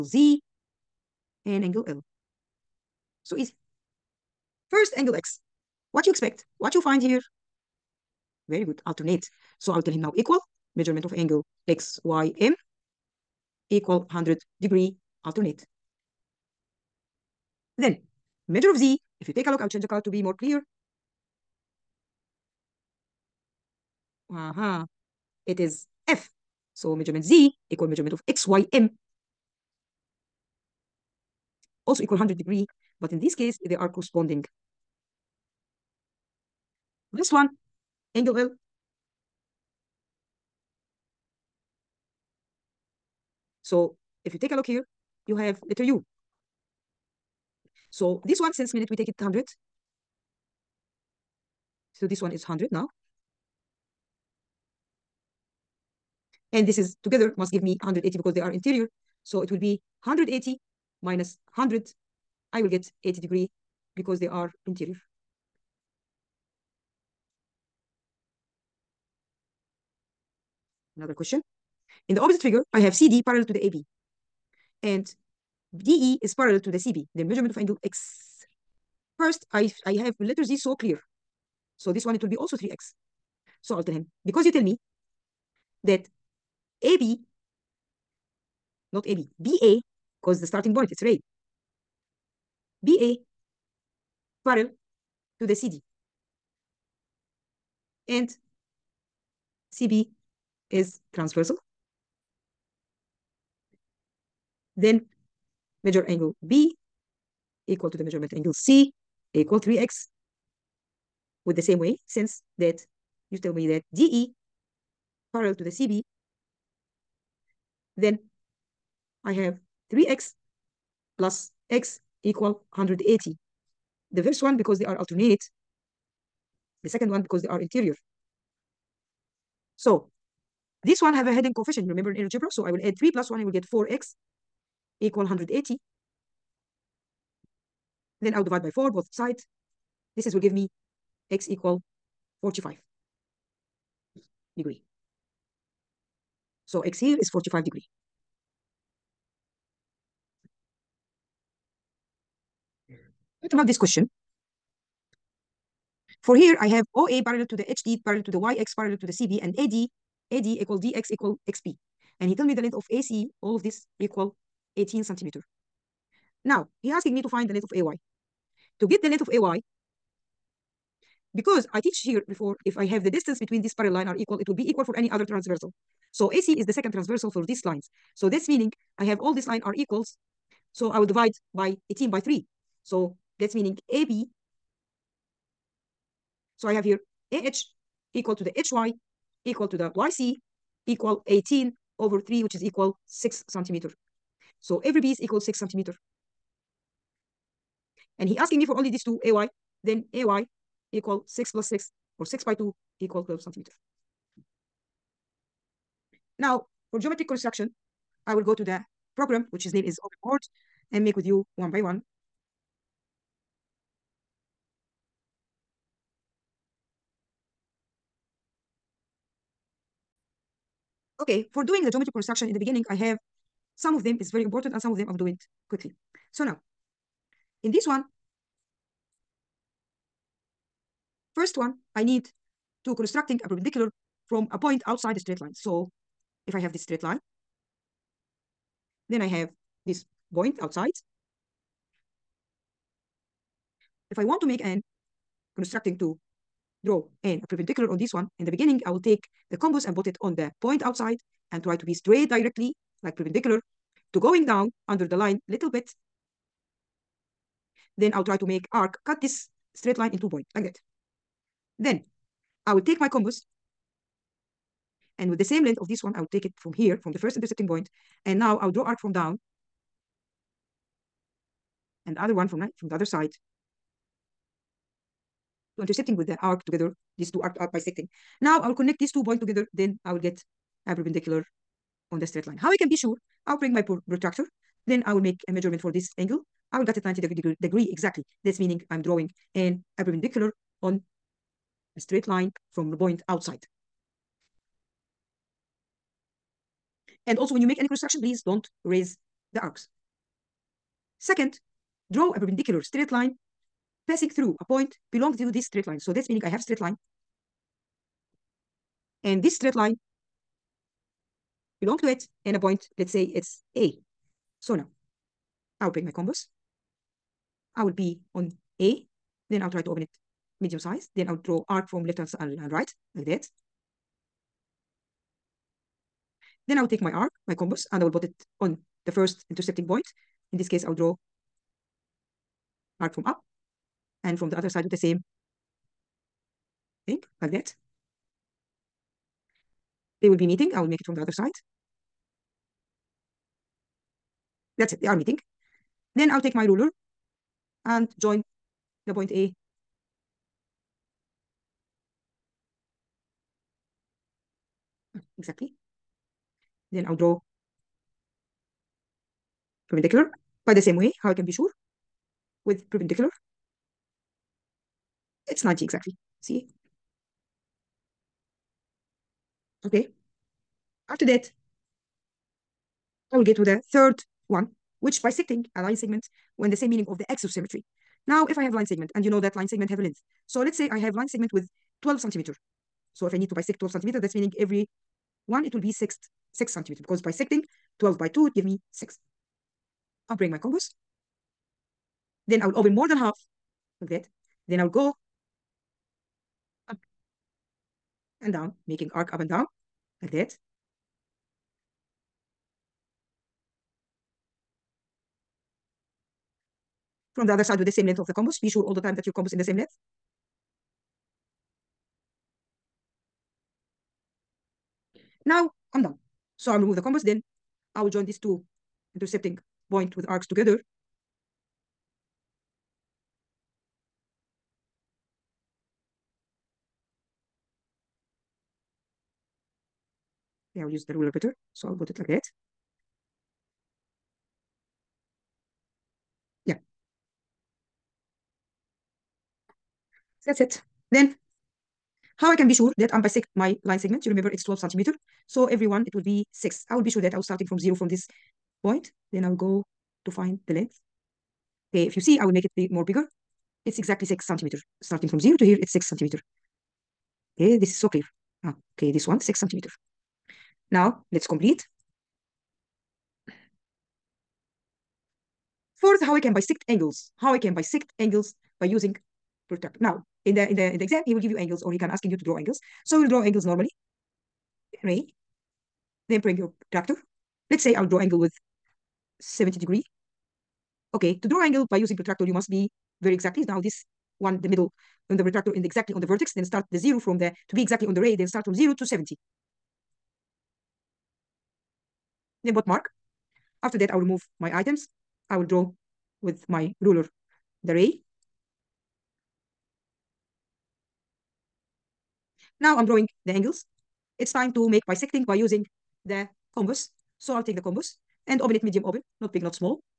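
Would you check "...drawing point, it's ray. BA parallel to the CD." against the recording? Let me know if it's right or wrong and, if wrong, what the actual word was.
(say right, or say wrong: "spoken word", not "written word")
wrong: "starting", not "drawing".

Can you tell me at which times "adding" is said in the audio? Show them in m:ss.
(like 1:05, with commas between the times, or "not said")
not said.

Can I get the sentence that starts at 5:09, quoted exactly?
And this straight line belong to it and a point, let's say it's A.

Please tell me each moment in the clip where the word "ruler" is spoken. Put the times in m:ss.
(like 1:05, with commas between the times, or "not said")
5:46, 7:11, 8:17.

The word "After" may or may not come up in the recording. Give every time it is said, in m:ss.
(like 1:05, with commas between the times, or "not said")
6:11, 8:13.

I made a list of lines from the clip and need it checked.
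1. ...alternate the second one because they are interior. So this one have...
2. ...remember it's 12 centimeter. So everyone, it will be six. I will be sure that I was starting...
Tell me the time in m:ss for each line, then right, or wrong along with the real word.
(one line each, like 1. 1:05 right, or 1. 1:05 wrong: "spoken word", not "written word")
1. 2:04 right
2. 7:24 right.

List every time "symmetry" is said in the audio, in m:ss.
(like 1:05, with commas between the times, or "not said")
6:17.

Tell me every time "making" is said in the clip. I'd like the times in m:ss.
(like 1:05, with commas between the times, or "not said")
6:38.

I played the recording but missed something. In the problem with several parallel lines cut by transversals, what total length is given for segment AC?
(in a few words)
18 centimeters.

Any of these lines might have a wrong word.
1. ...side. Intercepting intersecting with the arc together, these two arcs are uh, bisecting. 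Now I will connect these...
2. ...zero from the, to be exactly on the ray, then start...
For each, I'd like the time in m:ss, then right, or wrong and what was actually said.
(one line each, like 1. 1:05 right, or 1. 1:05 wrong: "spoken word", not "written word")
1. 4:33 right
2. 8:06 right.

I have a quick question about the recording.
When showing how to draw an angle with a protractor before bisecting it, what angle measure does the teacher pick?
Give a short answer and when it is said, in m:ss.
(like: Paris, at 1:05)
70 degrees, at 7:59.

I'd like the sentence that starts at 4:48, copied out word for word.
That's meaning I'm drawing an a perpendicular on a straight line from the point outside.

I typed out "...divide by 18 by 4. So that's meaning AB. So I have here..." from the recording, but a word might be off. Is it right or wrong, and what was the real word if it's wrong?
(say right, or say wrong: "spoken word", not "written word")
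wrong: "3", not "4".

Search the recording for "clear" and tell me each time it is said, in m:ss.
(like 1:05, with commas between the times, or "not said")
0:20, 1:20, 7:38.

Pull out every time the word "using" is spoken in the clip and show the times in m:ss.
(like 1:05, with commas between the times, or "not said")
7:48, 8:01, 8:25.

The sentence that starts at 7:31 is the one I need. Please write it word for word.
Okay, if you see, I will make it be more bigger it's exactly six centimeter.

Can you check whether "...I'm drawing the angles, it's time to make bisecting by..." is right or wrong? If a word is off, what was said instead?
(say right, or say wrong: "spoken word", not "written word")
right.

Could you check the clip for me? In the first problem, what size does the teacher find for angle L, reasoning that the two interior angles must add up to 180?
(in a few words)
80 degrees.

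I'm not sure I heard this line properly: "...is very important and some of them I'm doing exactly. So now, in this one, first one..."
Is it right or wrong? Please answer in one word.
wrong.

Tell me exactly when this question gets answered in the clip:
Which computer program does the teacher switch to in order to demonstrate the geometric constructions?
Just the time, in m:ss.
3:30.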